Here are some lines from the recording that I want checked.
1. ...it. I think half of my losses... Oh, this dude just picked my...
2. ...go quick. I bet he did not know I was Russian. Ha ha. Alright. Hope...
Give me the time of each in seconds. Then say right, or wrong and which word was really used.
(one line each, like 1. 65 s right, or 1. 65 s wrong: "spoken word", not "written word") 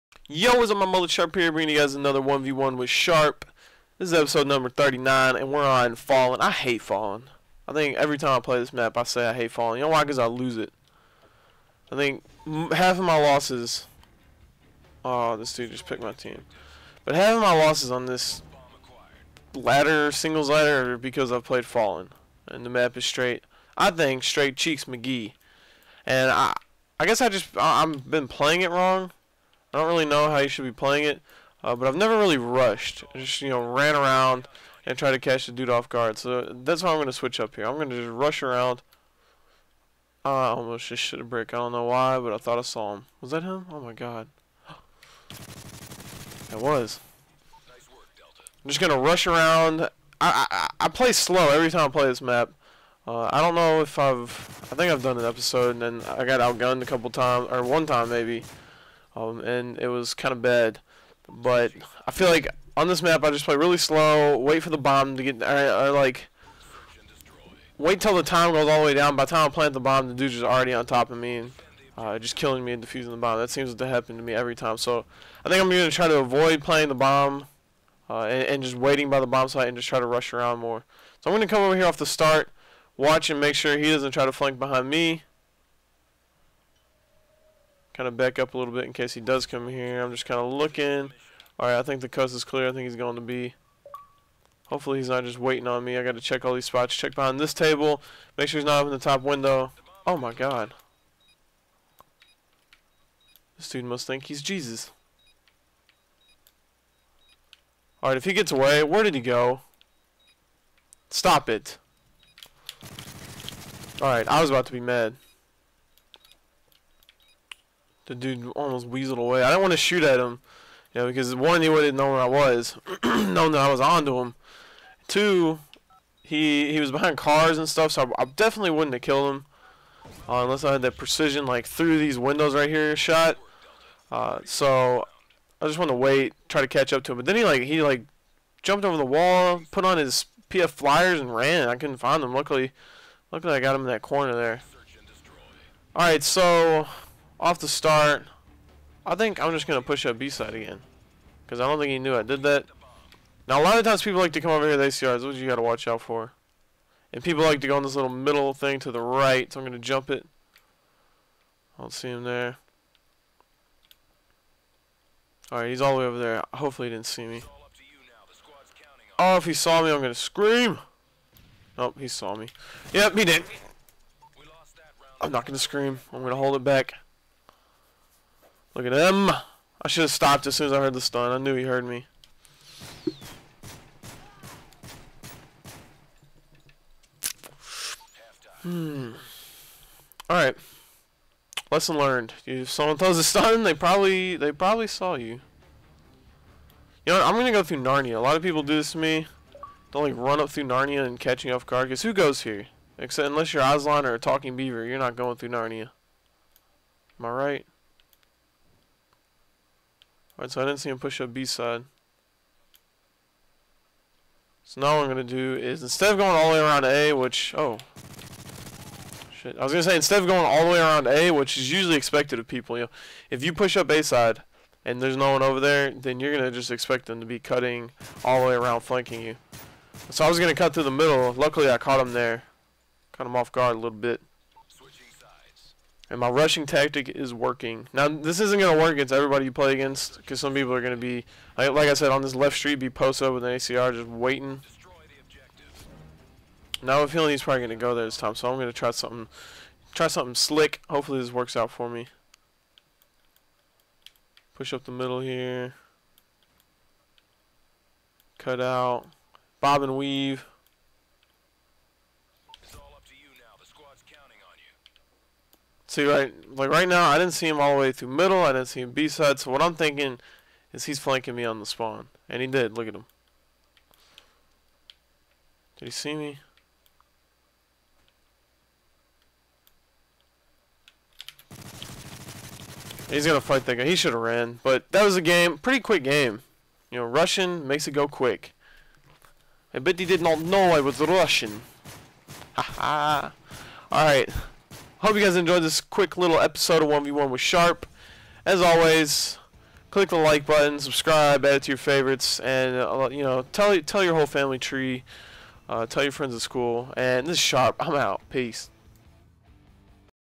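1. 10 s right
2. 287 s right.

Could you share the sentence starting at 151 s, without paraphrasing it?
Because I don't think he knew I did that.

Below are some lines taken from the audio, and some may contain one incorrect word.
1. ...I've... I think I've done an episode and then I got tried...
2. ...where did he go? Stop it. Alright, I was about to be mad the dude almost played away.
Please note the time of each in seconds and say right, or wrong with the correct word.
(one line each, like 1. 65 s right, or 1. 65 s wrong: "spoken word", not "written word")
1. 53 s wrong: "outgunned", not "tried"
2. 108 s wrong: "weaseled", not "played".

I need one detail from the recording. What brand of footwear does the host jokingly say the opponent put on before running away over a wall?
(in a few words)
PF Flyers.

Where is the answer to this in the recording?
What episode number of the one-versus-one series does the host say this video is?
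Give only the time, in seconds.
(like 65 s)
4 s.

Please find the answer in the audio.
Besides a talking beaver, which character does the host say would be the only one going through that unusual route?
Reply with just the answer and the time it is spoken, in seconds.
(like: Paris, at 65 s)
Aslan, at 203 s.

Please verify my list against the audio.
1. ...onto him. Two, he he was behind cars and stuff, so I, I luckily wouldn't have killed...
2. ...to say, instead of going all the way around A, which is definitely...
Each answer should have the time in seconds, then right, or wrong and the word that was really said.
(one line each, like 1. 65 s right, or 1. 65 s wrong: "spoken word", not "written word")
1. 123 s wrong: "definitely", not "luckily"
2. 219 s wrong: "usually", not "definitely".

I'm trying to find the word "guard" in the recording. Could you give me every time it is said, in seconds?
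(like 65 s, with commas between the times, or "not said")
35 s, 201 s, 233 s.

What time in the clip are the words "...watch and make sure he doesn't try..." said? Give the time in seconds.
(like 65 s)
82 s.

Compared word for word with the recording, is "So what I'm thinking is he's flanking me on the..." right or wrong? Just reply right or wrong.
right.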